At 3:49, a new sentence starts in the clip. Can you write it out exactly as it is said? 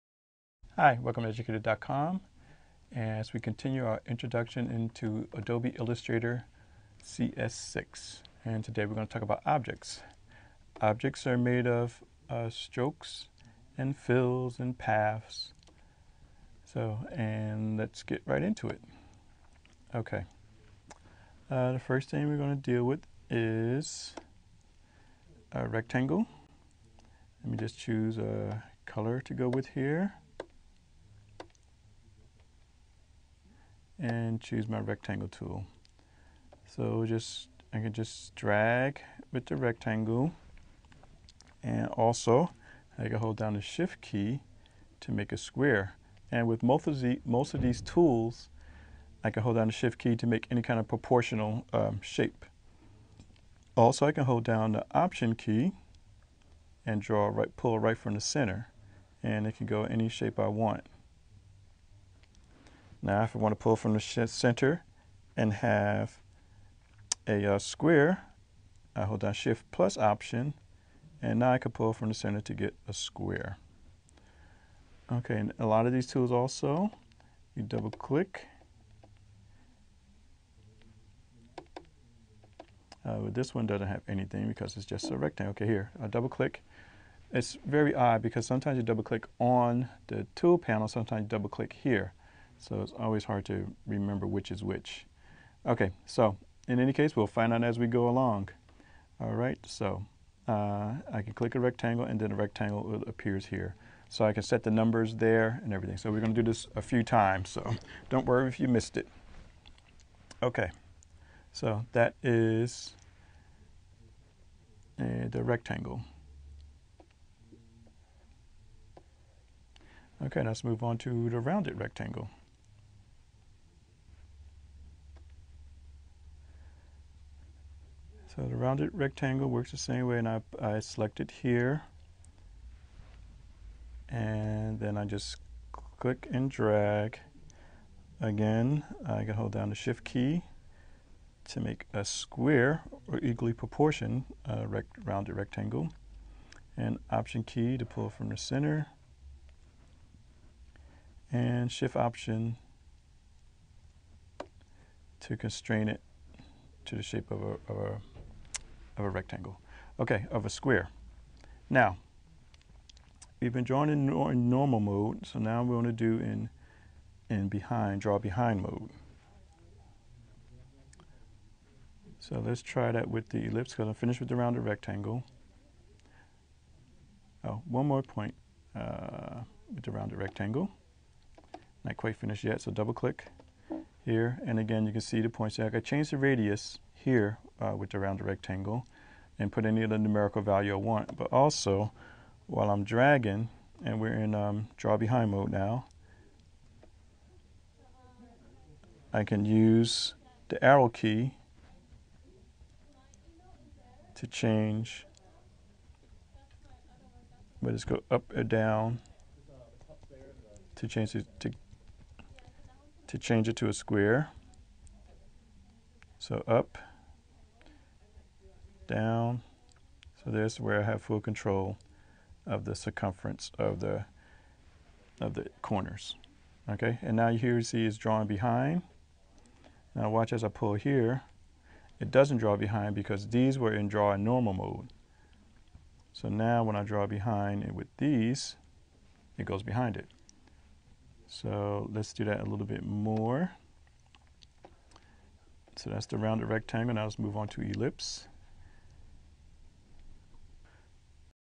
Now watch as I pull here.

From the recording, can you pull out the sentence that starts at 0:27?
Let me just choose a color to go with here.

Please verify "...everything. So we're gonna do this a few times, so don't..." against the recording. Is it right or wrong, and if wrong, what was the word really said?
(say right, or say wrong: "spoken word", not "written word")
right.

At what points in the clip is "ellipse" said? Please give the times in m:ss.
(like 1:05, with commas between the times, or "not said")
2:53, 4:07.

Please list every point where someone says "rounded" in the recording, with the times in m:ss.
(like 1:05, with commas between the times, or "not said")
2:01, 2:08, 2:25, 2:54, 2:59, 3:07, 4:06.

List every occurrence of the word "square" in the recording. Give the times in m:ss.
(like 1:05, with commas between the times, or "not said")
0:45, 1:07, 1:12, 2:22, 2:40, 3:33.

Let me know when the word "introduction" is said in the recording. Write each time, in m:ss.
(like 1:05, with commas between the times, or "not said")
0:04.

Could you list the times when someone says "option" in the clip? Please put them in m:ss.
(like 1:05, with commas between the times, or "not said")
0:54, 1:09, 2:27, 2:31.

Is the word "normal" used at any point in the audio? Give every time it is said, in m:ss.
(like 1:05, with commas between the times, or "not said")
2:44, 3:54.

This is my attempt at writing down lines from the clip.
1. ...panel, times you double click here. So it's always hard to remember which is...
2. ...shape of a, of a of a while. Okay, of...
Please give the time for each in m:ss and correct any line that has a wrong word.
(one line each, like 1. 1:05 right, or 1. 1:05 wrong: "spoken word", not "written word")
1. 1:30 wrong: "sometimes", not "times"
2. 2:37 wrong: "rectangle", not "while".